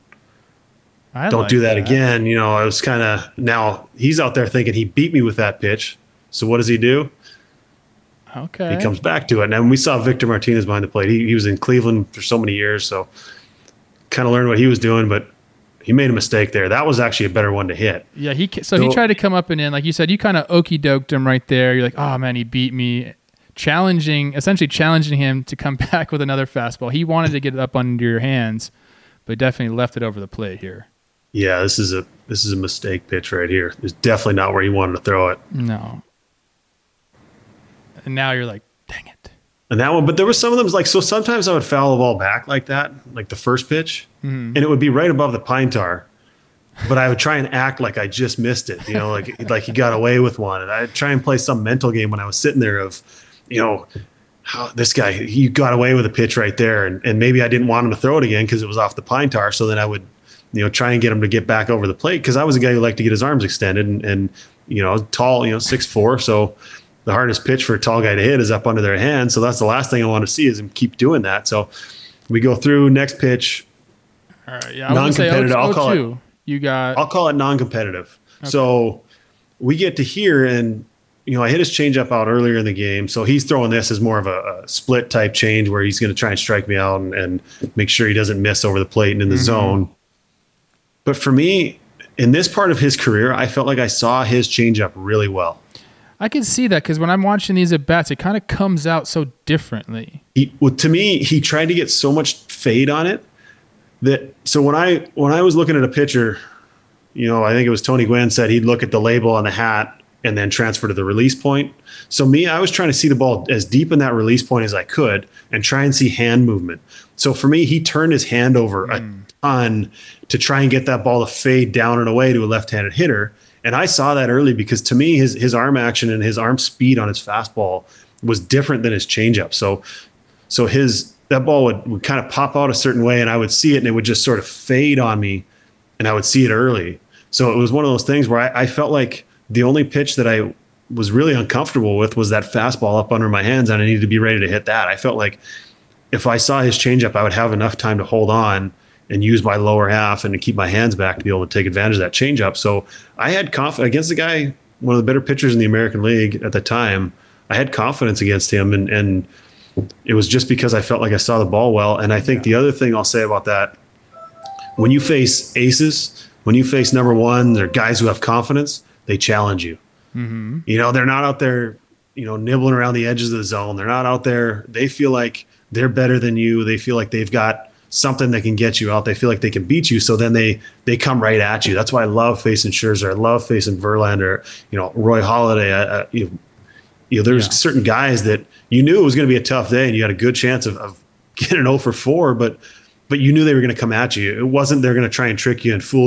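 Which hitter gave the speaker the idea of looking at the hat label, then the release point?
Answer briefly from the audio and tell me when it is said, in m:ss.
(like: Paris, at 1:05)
Tony Gwynn, at 1:47.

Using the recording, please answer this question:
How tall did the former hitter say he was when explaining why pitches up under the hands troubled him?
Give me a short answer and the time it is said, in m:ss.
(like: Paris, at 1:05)
6'4", at 1:05.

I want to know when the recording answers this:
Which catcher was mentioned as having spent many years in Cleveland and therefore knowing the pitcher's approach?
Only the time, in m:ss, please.
0:09.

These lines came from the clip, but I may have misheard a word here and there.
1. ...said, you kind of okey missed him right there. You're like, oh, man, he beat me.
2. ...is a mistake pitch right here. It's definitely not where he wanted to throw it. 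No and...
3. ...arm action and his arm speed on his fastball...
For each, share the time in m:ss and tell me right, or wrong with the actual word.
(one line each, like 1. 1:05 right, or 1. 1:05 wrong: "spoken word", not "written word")
1. 0:19 wrong: "doked", not "missed"
2. 0:32 right
3. 2:05 right.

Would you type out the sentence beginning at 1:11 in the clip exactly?
So we go through next pitch.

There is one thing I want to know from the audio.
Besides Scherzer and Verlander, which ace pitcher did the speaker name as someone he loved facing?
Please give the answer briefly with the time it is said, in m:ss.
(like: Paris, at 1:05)
Roy Halladay, at 3:04.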